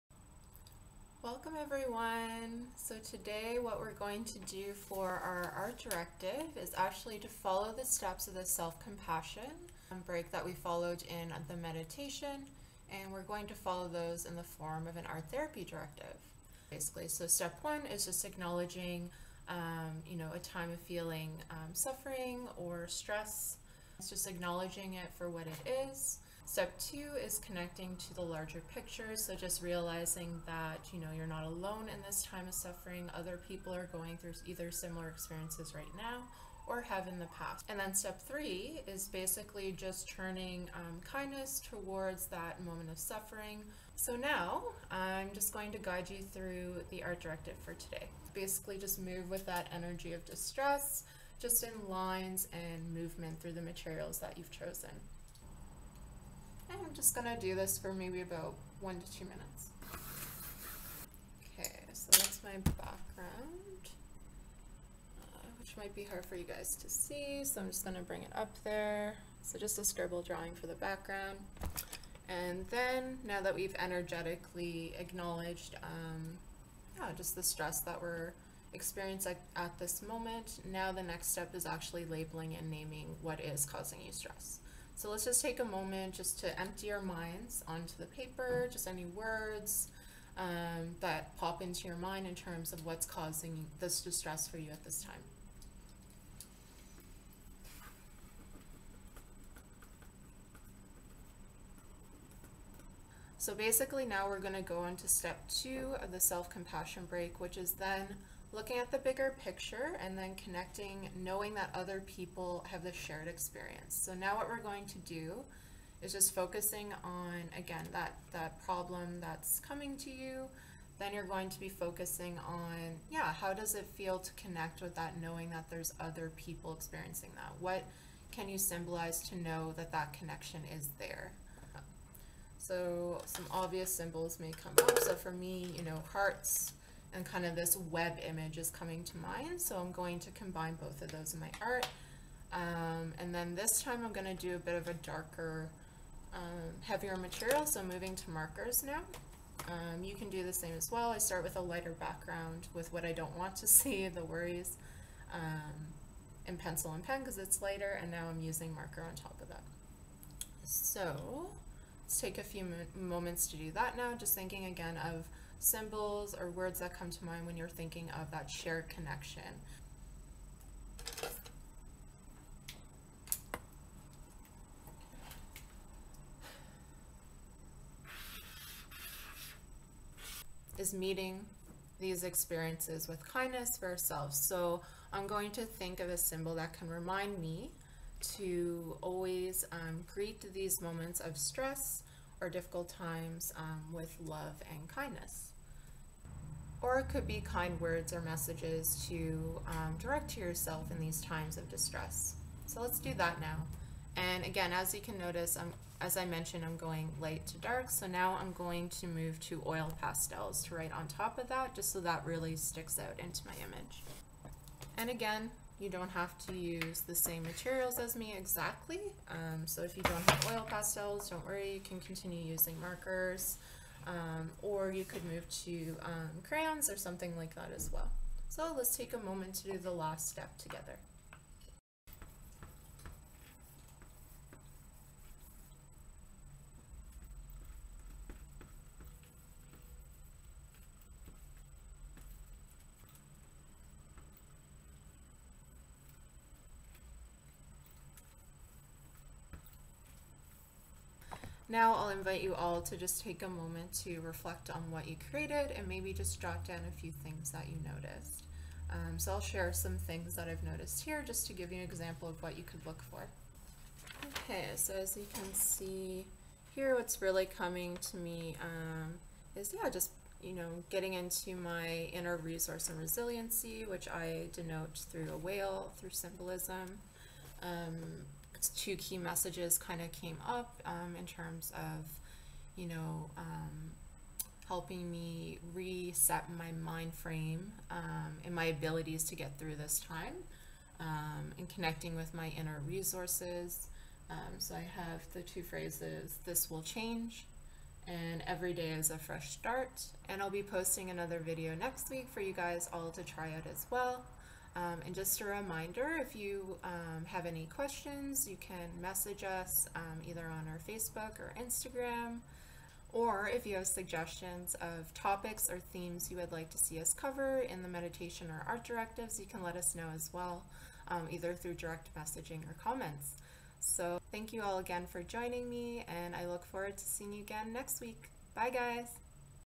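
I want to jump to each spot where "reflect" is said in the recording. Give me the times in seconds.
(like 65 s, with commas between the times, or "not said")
254 s.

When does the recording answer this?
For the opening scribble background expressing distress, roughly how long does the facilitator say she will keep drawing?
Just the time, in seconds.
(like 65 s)
58 s.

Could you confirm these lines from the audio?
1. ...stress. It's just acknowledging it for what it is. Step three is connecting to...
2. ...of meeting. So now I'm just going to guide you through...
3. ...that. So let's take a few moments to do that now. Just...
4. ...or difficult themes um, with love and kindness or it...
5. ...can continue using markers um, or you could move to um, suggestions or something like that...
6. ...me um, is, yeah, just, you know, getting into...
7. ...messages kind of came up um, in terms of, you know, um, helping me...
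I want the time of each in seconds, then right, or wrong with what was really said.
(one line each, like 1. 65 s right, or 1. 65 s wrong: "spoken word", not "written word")
1. 22 s wrong: "two", not "three"
2. 42 s wrong: "suffering", not "meeting"
3. 159 s right
4. 192 s wrong: "times", not "themes"
5. 221 s wrong: "crayons", not "suggestions"
6. 268 s right
7. 279 s right.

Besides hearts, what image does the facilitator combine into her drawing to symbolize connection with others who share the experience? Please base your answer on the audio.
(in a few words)
Web.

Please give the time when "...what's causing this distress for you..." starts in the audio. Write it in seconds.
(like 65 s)
92 s.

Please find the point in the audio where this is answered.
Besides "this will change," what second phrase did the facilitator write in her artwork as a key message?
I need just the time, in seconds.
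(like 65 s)
298 s.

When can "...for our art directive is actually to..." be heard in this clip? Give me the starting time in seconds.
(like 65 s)
4 s.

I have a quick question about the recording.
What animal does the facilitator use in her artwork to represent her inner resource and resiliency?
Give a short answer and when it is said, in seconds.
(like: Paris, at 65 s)
Whale, at 275 s.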